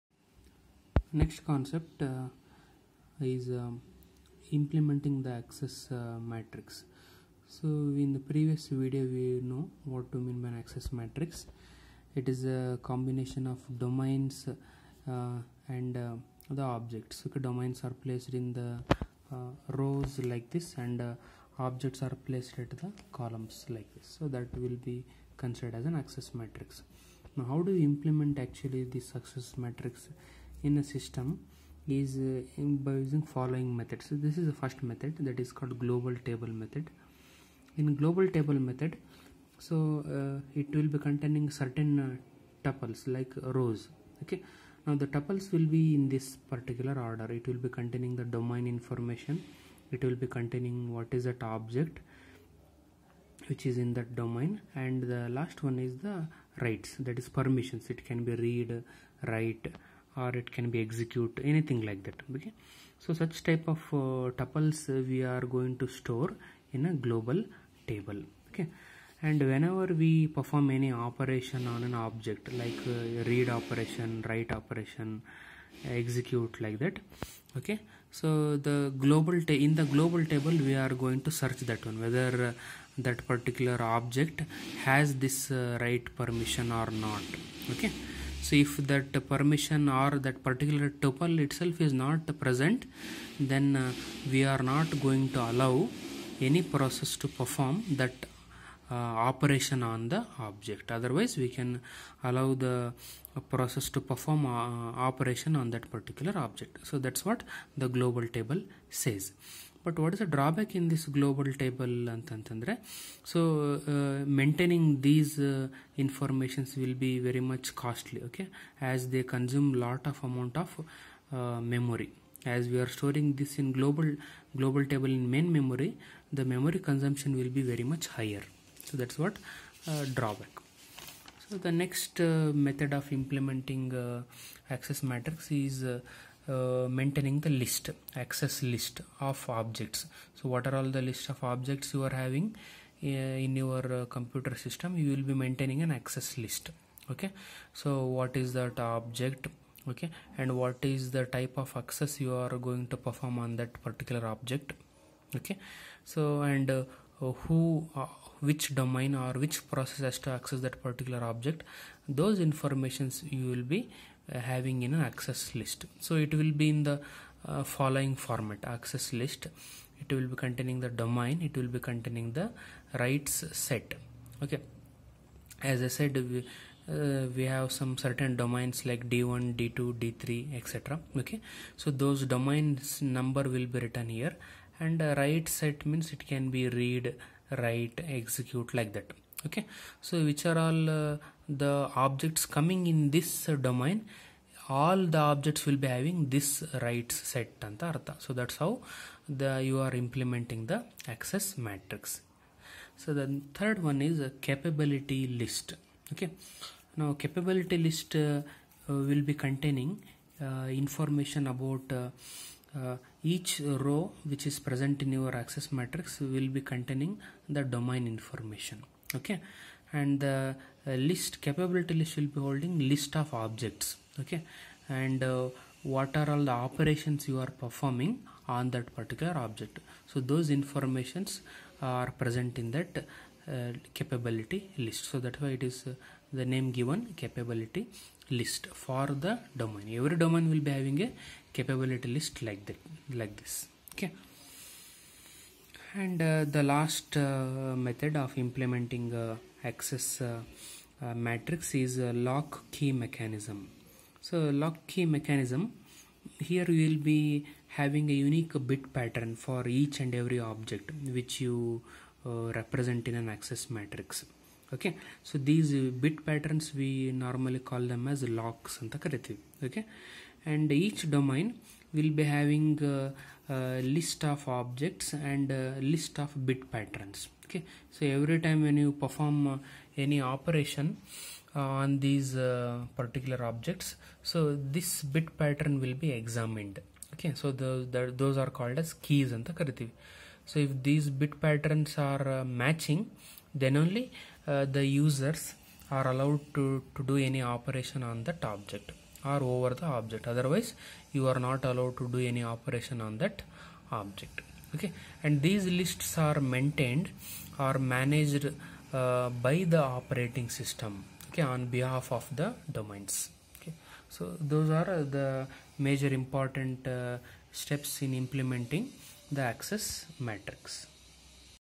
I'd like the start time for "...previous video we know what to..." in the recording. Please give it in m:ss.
0:08.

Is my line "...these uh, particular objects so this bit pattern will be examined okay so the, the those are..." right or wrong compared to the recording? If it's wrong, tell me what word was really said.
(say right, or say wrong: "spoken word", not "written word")
right.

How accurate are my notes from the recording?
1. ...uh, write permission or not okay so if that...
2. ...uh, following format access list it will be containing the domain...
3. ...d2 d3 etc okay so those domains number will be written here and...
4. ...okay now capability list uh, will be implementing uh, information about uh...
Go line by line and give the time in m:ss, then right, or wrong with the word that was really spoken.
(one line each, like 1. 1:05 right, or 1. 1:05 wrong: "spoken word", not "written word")
1. 1:25 right
2. 2:47 right
3. 2:59 right
4. 3:26 wrong: "containing", not "implementing".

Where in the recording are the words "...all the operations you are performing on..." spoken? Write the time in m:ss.
3:46.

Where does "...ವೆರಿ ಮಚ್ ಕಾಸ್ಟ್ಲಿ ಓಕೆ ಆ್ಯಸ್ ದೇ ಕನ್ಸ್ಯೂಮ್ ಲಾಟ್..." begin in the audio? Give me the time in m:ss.
1:57.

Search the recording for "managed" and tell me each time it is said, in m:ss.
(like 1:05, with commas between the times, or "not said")
5:07.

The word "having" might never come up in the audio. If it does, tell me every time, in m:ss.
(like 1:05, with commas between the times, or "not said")
2:22, 2:44, 3:15, 4:00, 4:17, 4:32.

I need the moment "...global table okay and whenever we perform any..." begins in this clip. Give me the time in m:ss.
1:07.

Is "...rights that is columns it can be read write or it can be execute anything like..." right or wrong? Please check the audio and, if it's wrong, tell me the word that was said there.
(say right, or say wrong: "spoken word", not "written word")
wrong: "permissions", not "columns".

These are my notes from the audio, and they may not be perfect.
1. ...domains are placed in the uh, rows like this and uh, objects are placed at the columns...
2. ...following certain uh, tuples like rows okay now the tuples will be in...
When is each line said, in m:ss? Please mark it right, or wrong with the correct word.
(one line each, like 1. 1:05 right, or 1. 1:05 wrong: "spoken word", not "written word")
1. 0:17 right
2. 0:40 wrong: "containing", not "following".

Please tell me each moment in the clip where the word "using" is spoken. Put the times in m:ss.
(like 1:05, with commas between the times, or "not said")
0:32.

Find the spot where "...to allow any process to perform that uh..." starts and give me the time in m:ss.
1:35.